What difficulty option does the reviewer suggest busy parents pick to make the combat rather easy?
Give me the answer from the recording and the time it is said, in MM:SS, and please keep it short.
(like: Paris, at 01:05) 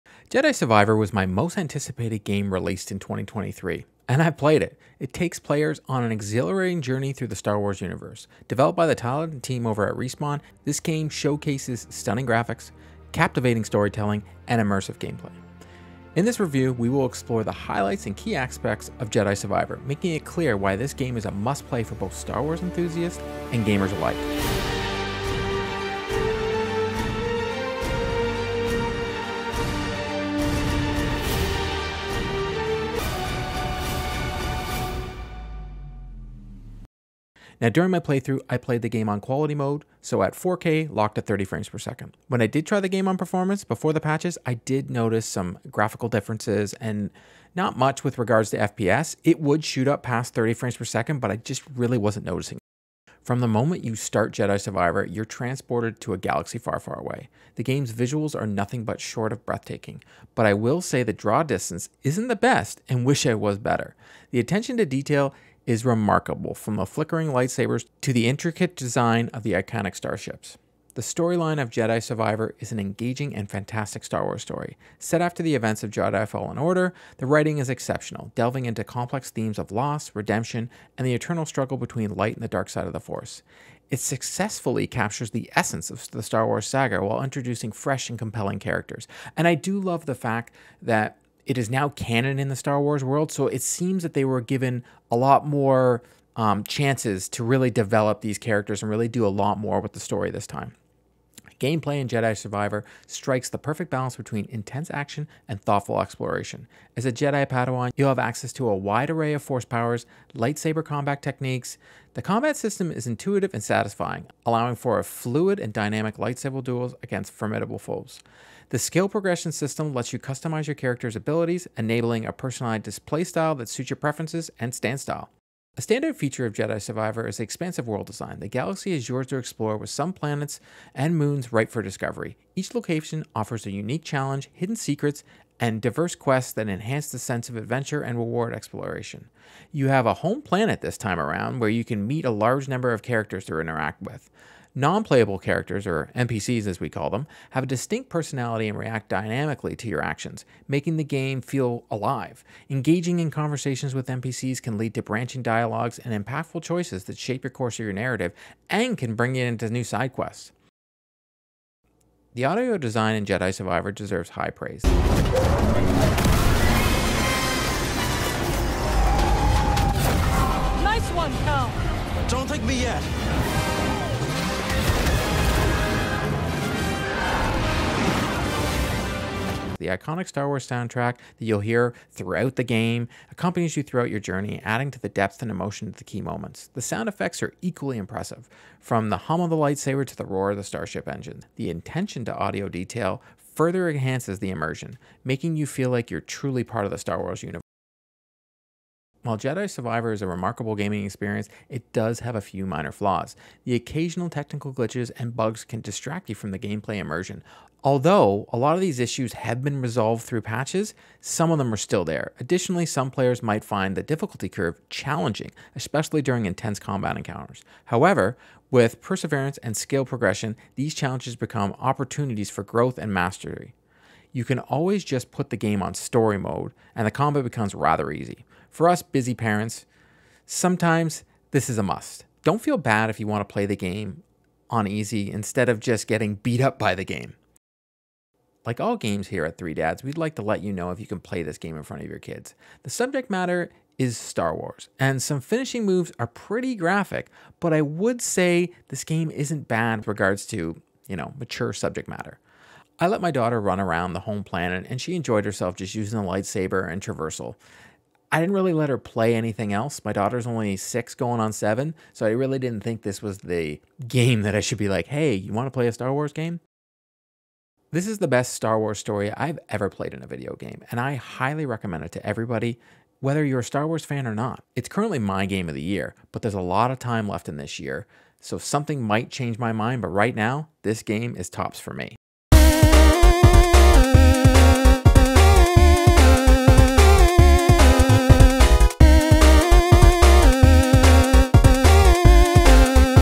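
Story mode, at 03:45.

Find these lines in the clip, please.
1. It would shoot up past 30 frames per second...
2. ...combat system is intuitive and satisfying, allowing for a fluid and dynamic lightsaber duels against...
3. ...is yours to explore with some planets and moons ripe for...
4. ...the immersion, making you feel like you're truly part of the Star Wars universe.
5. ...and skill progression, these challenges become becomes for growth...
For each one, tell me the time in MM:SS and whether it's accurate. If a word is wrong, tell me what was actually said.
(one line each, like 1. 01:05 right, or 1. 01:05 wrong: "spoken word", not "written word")
1. 00:49 right
2. 01:52 right
3. 02:08 right
4. 03:14 right
5. 03:39 wrong: "opportunities", not "becomes".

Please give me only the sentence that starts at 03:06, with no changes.
The sound effects are equally impressive, from the hum of the lightsaber to the roar of the starship engine.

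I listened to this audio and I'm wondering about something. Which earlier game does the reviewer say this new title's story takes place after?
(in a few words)
Jedi Fallen Order.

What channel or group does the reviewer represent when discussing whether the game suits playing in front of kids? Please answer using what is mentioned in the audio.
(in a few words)
Three Dads.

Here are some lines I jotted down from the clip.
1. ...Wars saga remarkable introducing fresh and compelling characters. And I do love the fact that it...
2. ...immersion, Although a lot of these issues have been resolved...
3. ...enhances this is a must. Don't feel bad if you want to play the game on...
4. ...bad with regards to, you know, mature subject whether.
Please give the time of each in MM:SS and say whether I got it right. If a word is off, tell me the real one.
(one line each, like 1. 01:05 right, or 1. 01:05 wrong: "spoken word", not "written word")
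1. 01:26 wrong: "while", not "remarkable"
2. 03:26 right
3. 03:50 wrong: "sometimes", not "enhances"
4. 04:09 wrong: "matter", not "whether".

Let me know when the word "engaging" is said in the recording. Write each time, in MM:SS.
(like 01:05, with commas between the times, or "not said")
01:12, 02:32.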